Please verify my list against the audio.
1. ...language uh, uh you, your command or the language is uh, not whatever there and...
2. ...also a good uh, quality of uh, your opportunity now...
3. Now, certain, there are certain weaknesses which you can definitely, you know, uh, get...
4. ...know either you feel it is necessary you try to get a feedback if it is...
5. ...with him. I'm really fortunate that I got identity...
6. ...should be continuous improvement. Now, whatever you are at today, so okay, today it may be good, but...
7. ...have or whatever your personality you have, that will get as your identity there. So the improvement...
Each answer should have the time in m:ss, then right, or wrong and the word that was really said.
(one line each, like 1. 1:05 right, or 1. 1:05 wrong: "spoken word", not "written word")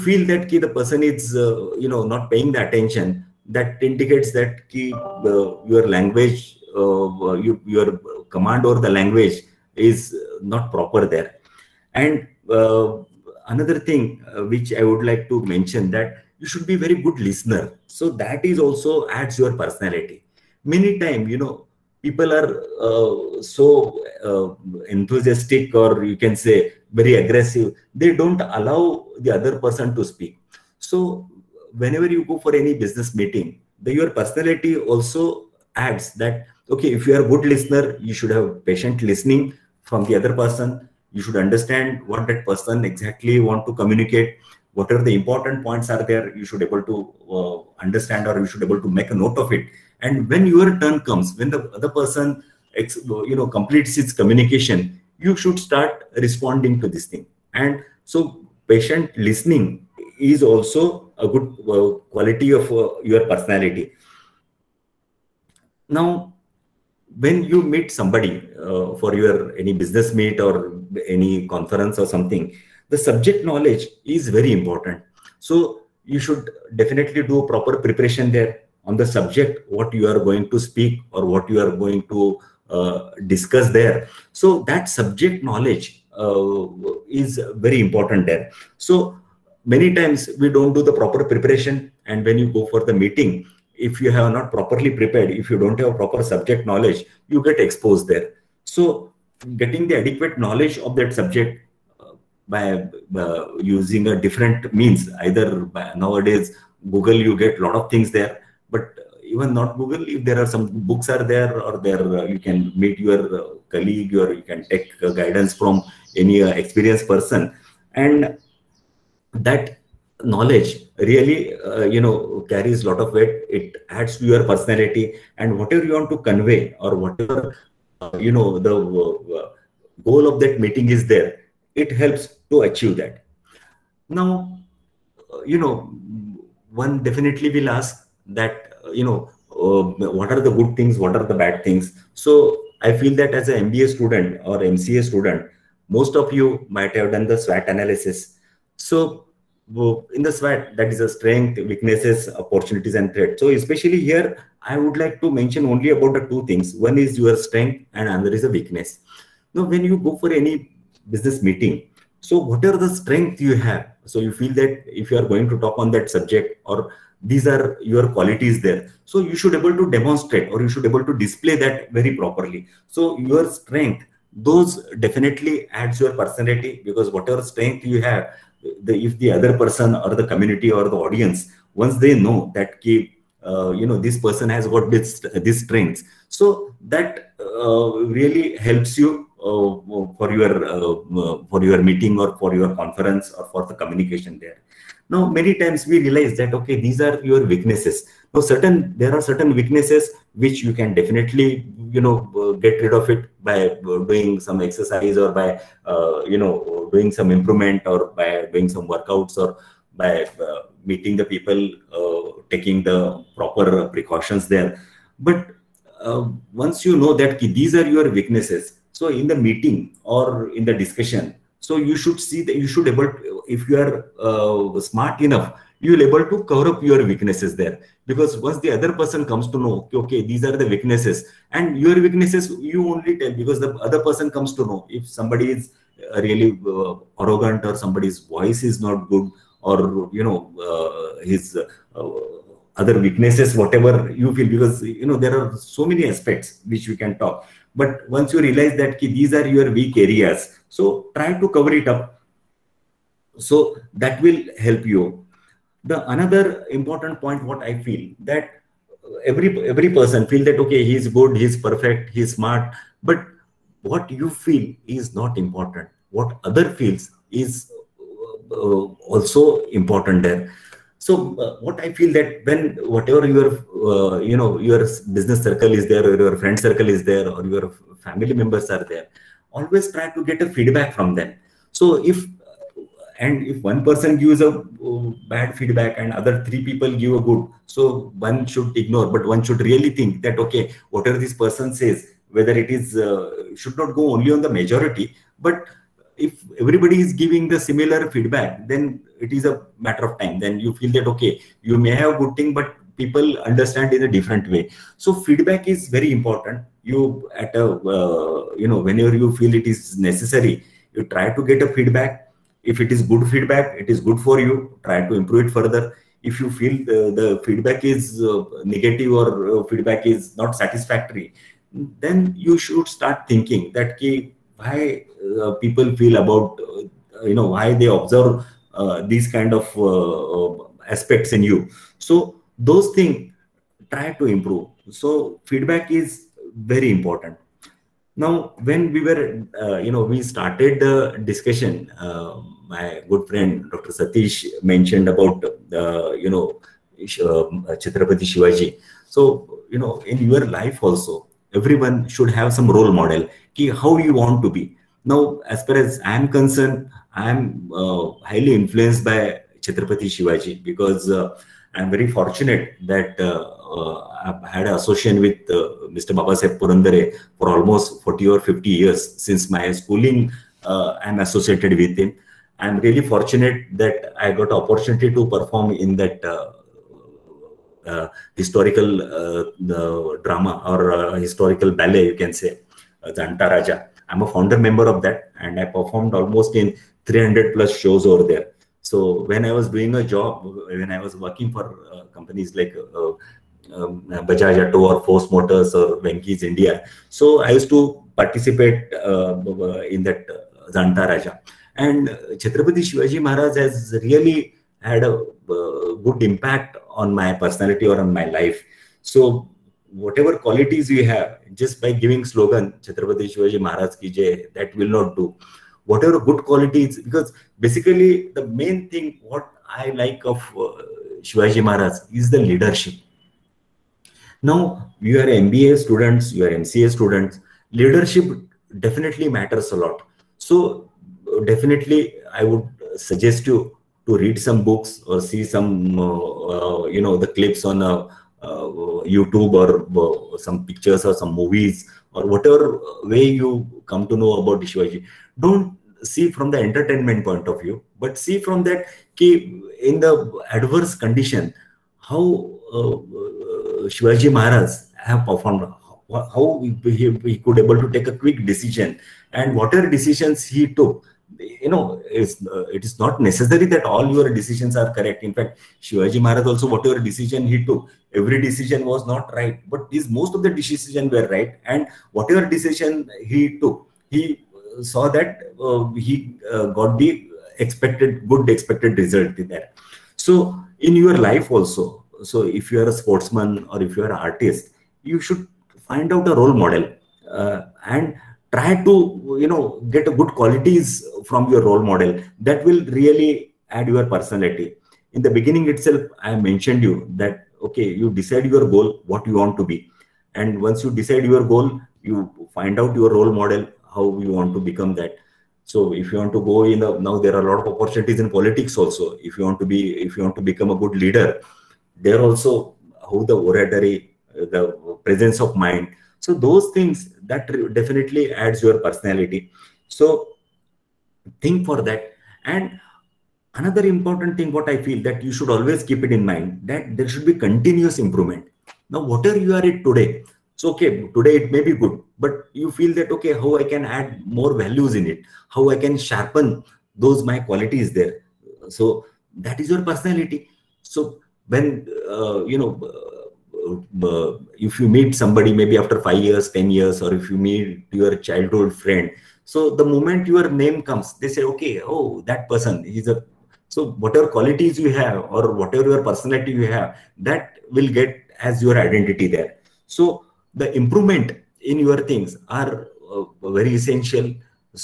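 1. 0:05 wrong: "proper", not "whatever"
2. 1:00 wrong: "personality", not "opportunity"
3. 3:18 right
4. 5:08 wrong: "whenever", not "either"
5. 6:11 wrong: "opportunity", not "identity"
6. 8:47 right
7. 9:14 right.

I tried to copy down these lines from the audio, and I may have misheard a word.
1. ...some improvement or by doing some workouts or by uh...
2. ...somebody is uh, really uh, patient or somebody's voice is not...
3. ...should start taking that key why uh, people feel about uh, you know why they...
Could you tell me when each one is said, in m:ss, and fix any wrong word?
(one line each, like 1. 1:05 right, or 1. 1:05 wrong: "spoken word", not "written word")
1. 3:27 right
2. 3:55 wrong: "arrogant", not "patient"
3. 5:22 wrong: "thinking", not "taking".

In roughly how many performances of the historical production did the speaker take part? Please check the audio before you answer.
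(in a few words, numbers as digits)
300+.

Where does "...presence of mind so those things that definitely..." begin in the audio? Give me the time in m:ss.
8:35.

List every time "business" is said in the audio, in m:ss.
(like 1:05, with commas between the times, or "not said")
0:32, 1:09, 2:41, 4:35.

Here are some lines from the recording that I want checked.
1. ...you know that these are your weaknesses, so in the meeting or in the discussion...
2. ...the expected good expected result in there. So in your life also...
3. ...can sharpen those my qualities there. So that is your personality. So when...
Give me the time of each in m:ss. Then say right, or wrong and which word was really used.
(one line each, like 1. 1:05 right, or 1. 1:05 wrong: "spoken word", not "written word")
1. 3:36 right
2. 7:56 right
3. 8:55 right.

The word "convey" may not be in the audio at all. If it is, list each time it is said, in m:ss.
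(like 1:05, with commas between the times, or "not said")
2:06.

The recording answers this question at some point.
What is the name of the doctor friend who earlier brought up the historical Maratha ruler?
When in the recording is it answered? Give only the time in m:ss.
5:43.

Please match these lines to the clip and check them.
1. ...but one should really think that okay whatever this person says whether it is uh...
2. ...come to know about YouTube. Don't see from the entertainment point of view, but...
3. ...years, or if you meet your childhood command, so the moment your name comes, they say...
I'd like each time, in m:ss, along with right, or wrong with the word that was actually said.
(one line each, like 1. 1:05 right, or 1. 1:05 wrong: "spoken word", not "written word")
1. 4:49 right
2. 7:23 wrong: "Shivaji", not "YouTube"
3. 9:06 wrong: "friend", not "command".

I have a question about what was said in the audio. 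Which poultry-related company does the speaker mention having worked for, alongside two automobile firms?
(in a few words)
Venky's India.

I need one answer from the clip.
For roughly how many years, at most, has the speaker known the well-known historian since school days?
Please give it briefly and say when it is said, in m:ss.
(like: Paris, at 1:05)
50, at 6:08.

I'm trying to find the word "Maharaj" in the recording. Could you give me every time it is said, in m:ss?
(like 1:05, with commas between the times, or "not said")
6:43, 6:53, 7:01, 7:34, 7:46.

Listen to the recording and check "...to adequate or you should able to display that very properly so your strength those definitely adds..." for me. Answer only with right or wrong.
wrong.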